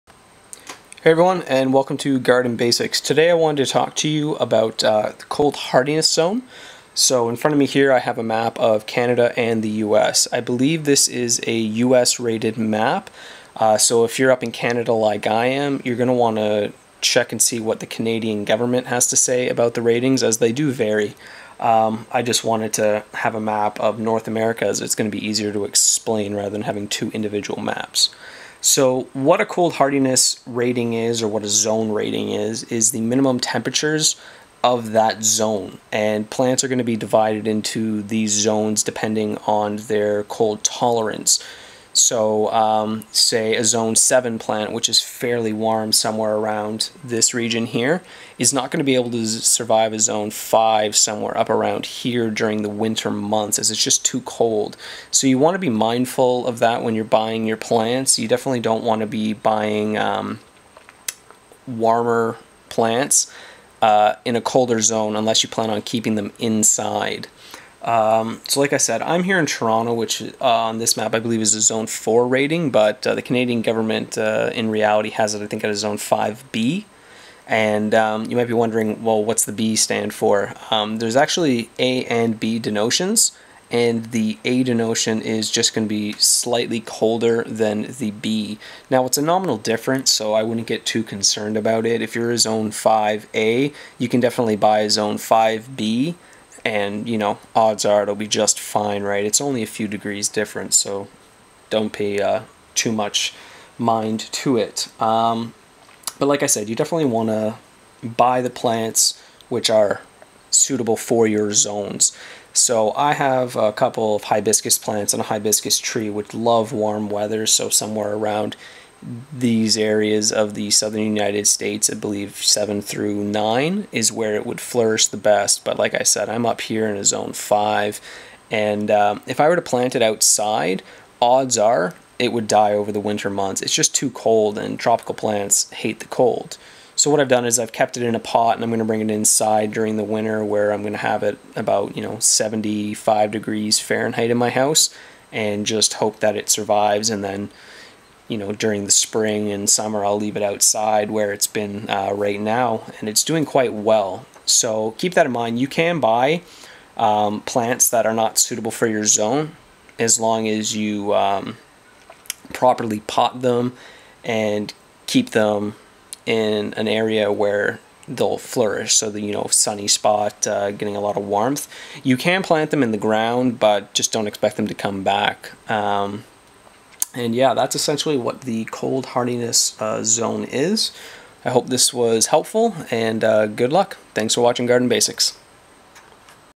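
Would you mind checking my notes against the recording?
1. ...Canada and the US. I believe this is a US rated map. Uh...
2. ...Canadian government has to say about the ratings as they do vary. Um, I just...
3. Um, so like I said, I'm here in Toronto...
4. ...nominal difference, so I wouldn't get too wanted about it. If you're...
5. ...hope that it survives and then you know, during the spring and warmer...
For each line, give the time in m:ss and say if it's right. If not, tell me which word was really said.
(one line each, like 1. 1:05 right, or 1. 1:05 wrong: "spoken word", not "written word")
1. 0:08 right
2. 0:17 right
3. 1:07 right
4. 1:29 wrong: "concerned", not "wanted"
5. 2:25 wrong: "summer", not "warmer".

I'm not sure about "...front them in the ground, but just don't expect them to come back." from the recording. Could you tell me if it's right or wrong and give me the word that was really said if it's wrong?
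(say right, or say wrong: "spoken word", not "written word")
wrong: "plant", not "front".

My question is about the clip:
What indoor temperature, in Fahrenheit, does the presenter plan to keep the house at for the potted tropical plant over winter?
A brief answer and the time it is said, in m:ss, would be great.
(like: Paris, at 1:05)
75 degrees Fahrenheit, at 2:22.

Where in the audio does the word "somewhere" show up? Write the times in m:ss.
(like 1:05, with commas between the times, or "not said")
0:45, 0:50, 1:57.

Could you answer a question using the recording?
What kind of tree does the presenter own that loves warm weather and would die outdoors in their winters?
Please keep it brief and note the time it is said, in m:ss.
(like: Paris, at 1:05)
hibiscus tree, at 1:55.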